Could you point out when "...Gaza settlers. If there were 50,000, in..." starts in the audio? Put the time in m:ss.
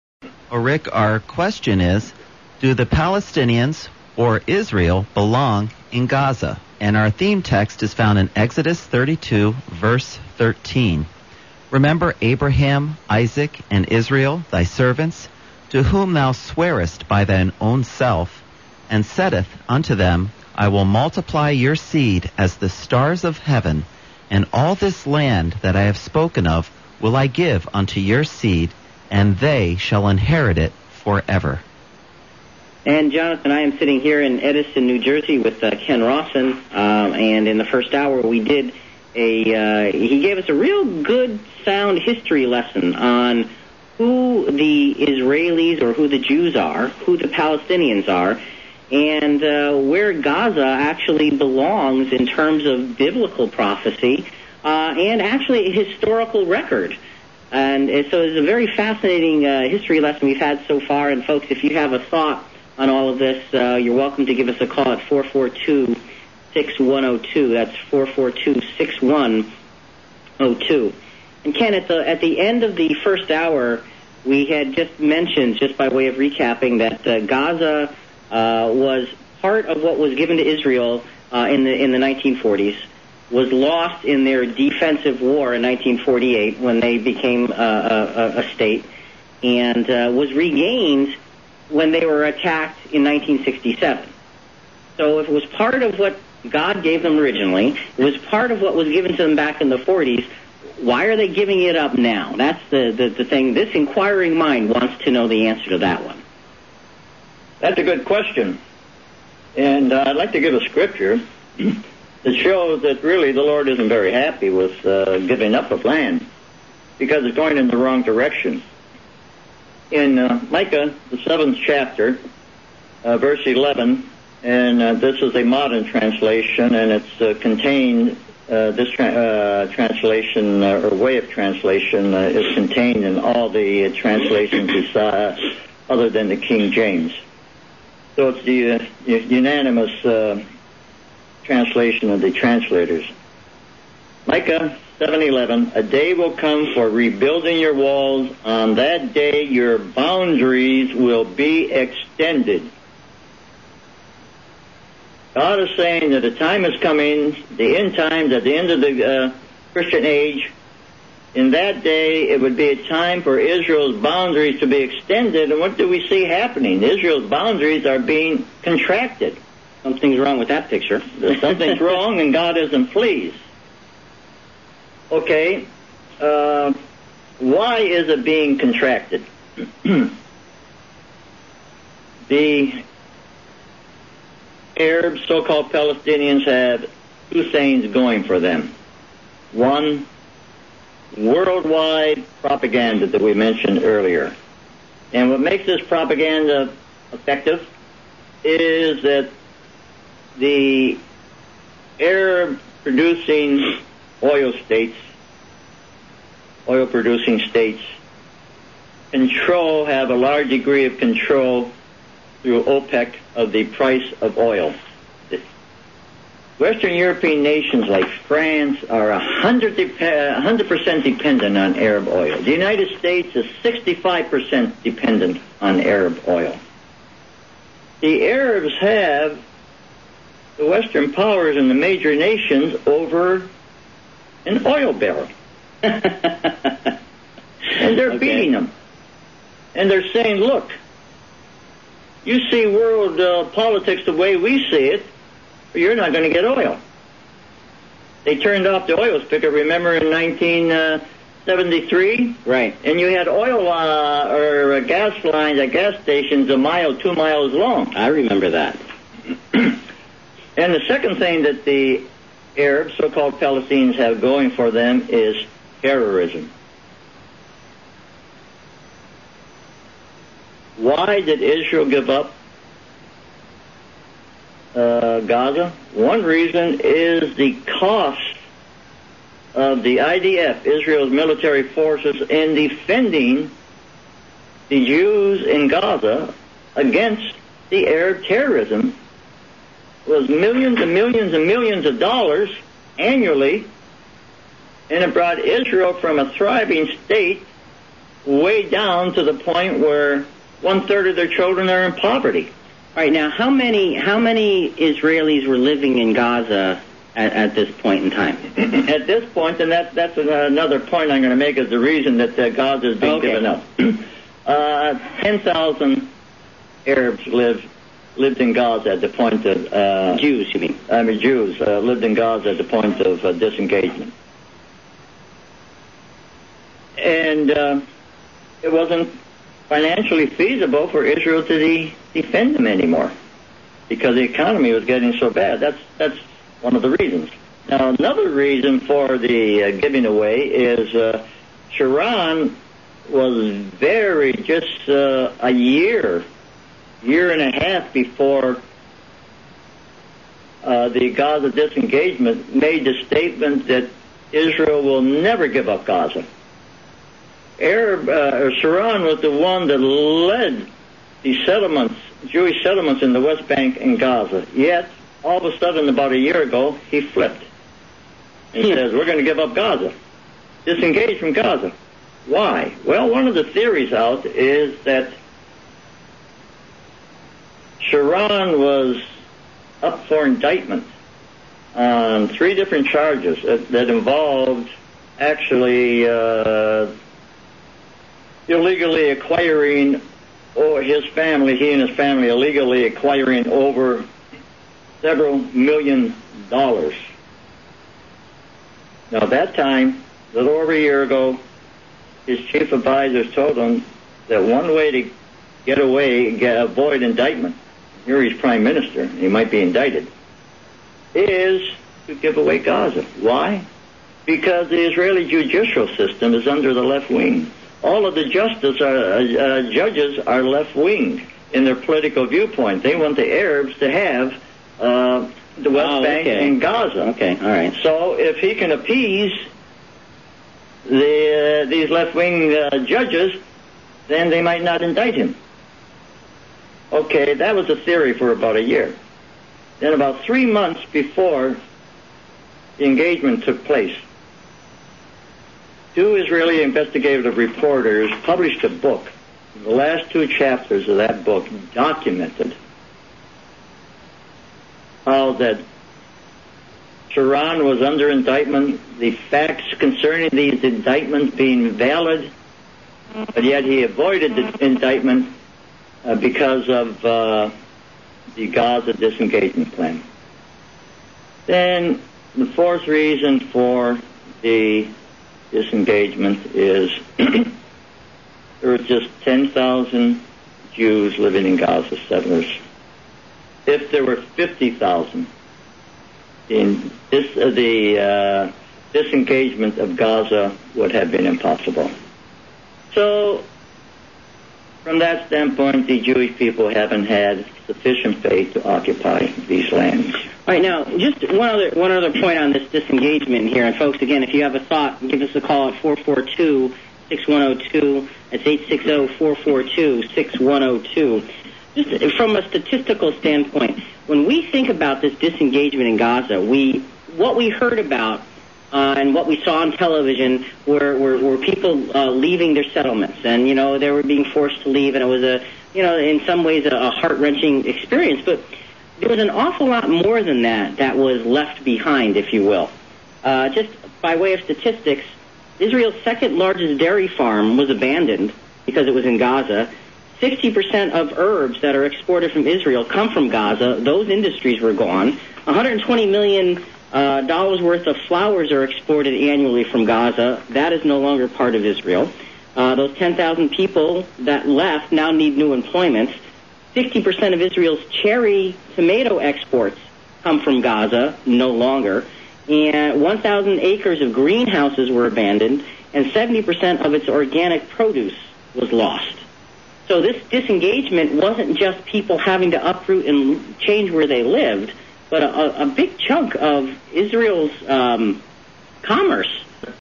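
8:01.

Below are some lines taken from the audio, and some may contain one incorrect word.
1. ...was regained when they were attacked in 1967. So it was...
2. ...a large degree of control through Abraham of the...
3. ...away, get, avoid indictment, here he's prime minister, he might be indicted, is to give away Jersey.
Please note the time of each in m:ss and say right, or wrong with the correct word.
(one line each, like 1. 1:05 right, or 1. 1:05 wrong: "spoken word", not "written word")
1. 1:30 right
2. 3:30 wrong: "OPEC", not "Abraham"
3. 6:45 wrong: "Gaza", not "Jersey".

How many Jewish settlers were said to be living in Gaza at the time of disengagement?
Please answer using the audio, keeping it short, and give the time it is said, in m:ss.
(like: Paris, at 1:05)
10,000, at 5:15.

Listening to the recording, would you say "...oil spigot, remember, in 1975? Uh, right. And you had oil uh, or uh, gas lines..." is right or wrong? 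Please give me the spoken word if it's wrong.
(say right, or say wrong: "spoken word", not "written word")
wrong: "1973", not "1975".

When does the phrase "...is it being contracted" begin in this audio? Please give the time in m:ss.
2:57.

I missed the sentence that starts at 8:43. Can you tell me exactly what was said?
And, you know, they were being forced to leave.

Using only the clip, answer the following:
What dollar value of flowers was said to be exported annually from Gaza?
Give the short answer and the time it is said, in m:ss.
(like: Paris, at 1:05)
$120 million, at 9:05.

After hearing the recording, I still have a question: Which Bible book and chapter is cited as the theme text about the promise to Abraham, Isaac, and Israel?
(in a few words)
Exodus 32.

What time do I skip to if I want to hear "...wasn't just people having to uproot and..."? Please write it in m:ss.
9:31.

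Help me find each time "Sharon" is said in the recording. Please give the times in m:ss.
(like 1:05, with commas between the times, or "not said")
5:41, 5:58, 6:17, 7:37.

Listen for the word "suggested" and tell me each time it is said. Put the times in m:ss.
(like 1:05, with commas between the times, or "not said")
not said.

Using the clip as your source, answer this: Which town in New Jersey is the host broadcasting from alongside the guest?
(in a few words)
Edison.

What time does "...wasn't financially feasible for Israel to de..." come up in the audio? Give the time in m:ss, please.
5:28.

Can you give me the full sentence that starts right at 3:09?
One, worldwide propaganda that we mentioned earlier.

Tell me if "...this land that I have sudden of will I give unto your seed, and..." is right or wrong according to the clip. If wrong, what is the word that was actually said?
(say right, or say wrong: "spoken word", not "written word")
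wrong: "spoken", not "sudden".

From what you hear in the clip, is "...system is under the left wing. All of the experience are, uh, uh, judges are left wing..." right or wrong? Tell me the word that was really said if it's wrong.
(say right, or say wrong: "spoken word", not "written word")
wrong: "justice", not "experience".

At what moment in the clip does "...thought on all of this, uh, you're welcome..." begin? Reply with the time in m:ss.
1:01.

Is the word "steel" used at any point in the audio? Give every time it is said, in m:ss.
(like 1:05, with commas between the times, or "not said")
not said.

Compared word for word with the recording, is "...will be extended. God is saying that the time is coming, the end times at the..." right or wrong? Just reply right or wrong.
right.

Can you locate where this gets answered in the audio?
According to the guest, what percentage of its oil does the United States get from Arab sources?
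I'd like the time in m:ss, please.
3:43.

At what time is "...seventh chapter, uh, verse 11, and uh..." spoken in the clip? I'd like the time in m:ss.
2:01.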